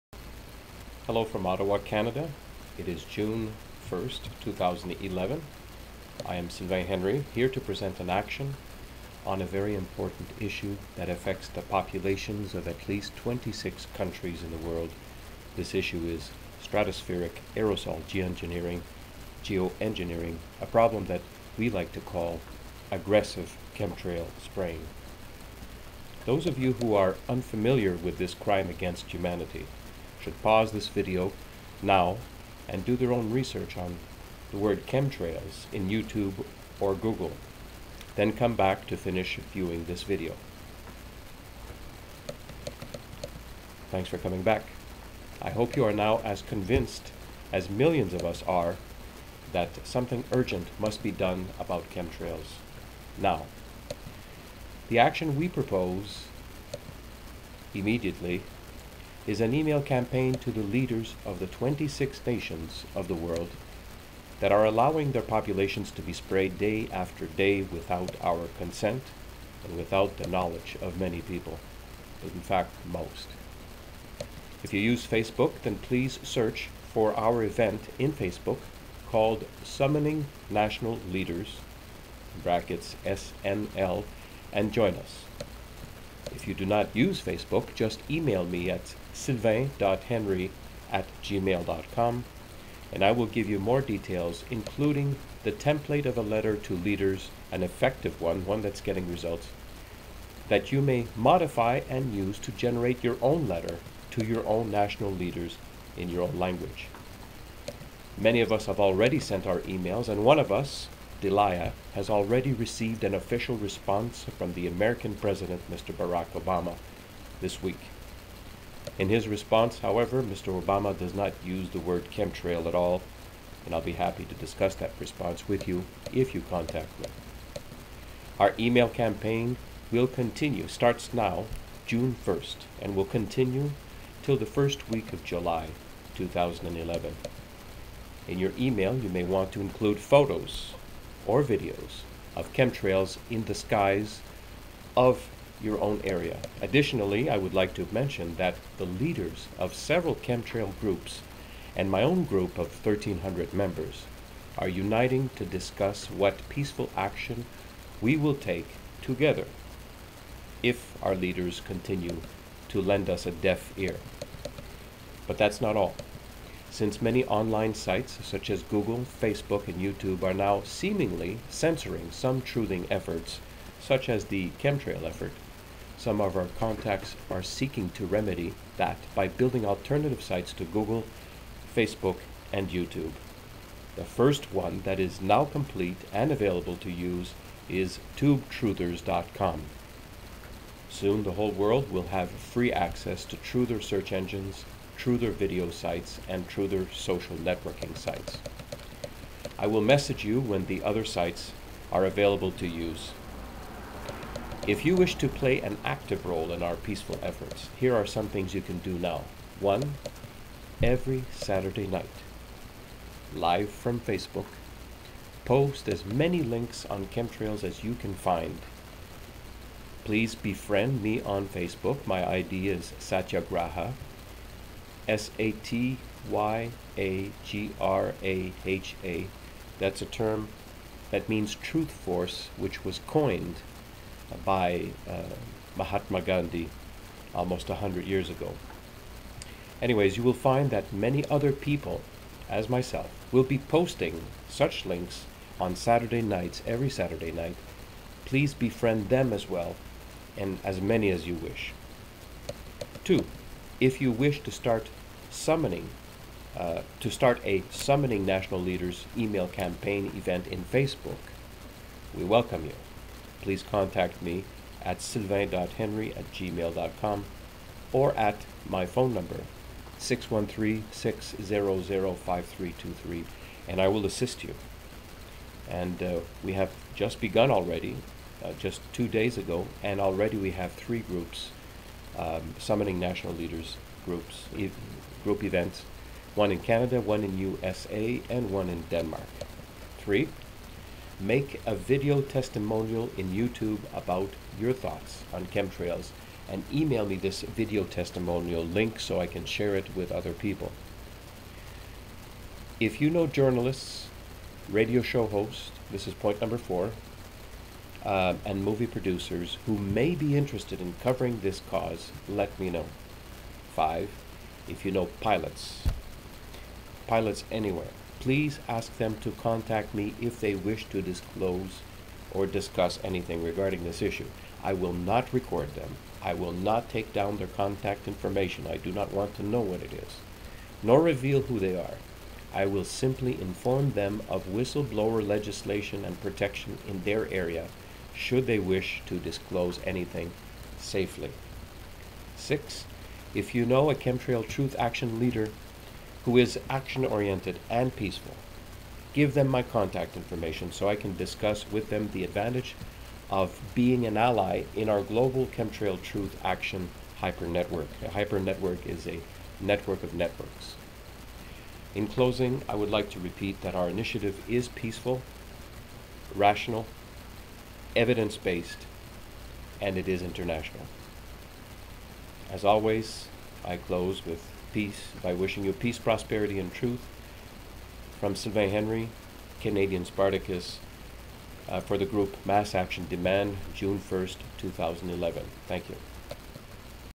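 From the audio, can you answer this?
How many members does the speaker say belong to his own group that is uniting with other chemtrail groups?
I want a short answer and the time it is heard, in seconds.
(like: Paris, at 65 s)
1,300, at 152 s.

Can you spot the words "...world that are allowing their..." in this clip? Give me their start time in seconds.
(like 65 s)
63 s.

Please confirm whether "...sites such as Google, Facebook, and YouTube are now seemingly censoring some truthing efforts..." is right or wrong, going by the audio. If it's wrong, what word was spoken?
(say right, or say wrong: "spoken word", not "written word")
right.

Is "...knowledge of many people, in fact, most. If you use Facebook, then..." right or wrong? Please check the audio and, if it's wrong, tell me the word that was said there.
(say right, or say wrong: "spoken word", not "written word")
right.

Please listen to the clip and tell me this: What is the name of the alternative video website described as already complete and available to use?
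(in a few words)
tubetruthers.com.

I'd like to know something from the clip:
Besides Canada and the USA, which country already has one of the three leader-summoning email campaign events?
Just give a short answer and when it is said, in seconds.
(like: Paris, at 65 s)
Denmark, at 288 s.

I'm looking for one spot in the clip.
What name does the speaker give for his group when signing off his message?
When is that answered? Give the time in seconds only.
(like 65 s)
382 s.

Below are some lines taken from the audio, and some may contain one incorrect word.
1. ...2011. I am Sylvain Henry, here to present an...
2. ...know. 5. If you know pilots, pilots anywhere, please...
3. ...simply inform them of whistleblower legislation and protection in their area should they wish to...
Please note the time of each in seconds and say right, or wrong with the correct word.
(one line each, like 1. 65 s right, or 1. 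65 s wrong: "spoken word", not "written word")
1. 4 s right
2. 312 s right
3. 332 s right.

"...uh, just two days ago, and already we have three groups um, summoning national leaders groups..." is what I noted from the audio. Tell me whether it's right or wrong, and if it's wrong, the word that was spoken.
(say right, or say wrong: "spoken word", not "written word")
right.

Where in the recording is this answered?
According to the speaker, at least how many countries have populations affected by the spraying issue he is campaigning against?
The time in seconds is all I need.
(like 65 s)
13 s.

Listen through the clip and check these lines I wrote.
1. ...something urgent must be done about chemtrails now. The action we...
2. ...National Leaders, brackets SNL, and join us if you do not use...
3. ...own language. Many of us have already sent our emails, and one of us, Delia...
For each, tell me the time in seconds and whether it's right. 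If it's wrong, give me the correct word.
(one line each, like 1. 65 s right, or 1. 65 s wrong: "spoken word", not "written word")
1. 49 s right
2. 80 s right
3. 106 s right.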